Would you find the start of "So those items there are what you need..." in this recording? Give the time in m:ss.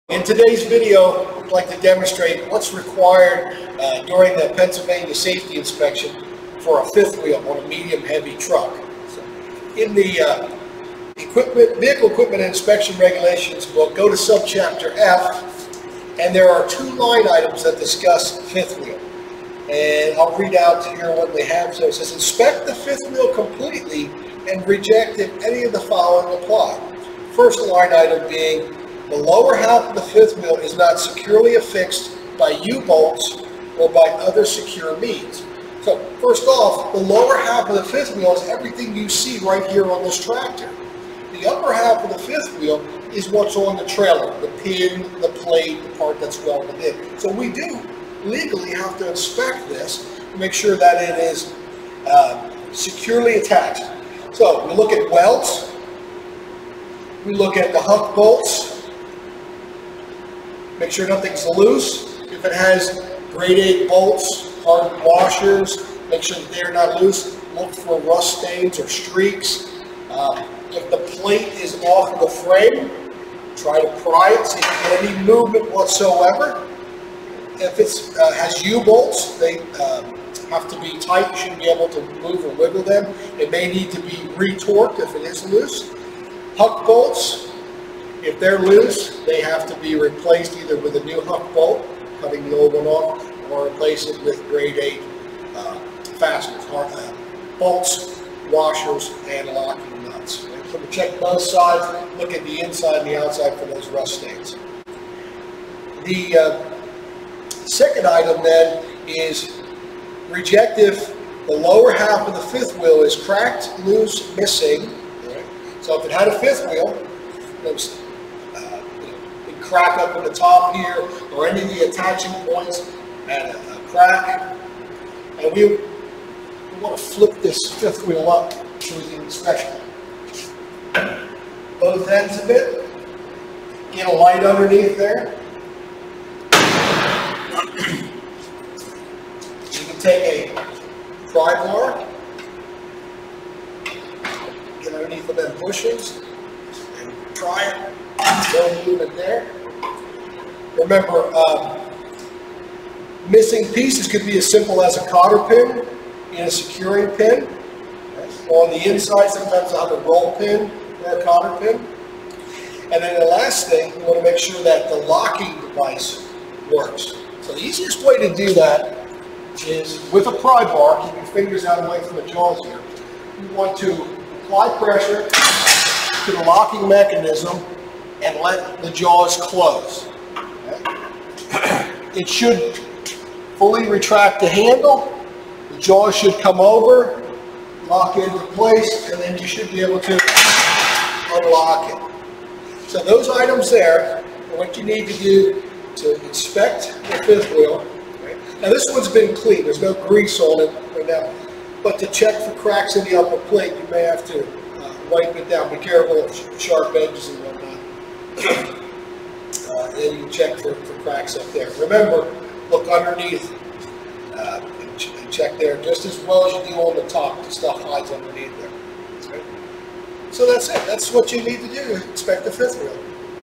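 3:12.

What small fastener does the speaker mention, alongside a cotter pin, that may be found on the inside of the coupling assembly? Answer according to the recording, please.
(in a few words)
Roll pin.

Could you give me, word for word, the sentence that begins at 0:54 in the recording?
So we look at welds, we look at the huck bolts, Make sure nothing's loose.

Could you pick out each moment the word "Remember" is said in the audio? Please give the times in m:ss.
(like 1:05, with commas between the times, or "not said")
2:30, 3:31.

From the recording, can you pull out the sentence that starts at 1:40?
So check both sides, look at the inside and the outside for those rust stains.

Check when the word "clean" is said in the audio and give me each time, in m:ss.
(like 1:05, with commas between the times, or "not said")
3:19.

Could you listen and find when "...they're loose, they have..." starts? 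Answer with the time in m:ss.
1:28.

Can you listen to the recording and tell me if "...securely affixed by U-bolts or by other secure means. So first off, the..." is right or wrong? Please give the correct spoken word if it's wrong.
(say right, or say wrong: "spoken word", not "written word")
right.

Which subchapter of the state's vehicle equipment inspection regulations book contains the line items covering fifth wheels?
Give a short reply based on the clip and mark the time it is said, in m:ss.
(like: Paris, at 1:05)
Subchapter F, at 0:14.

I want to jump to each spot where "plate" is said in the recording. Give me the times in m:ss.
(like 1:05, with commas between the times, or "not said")
0:45, 1:11, 3:23.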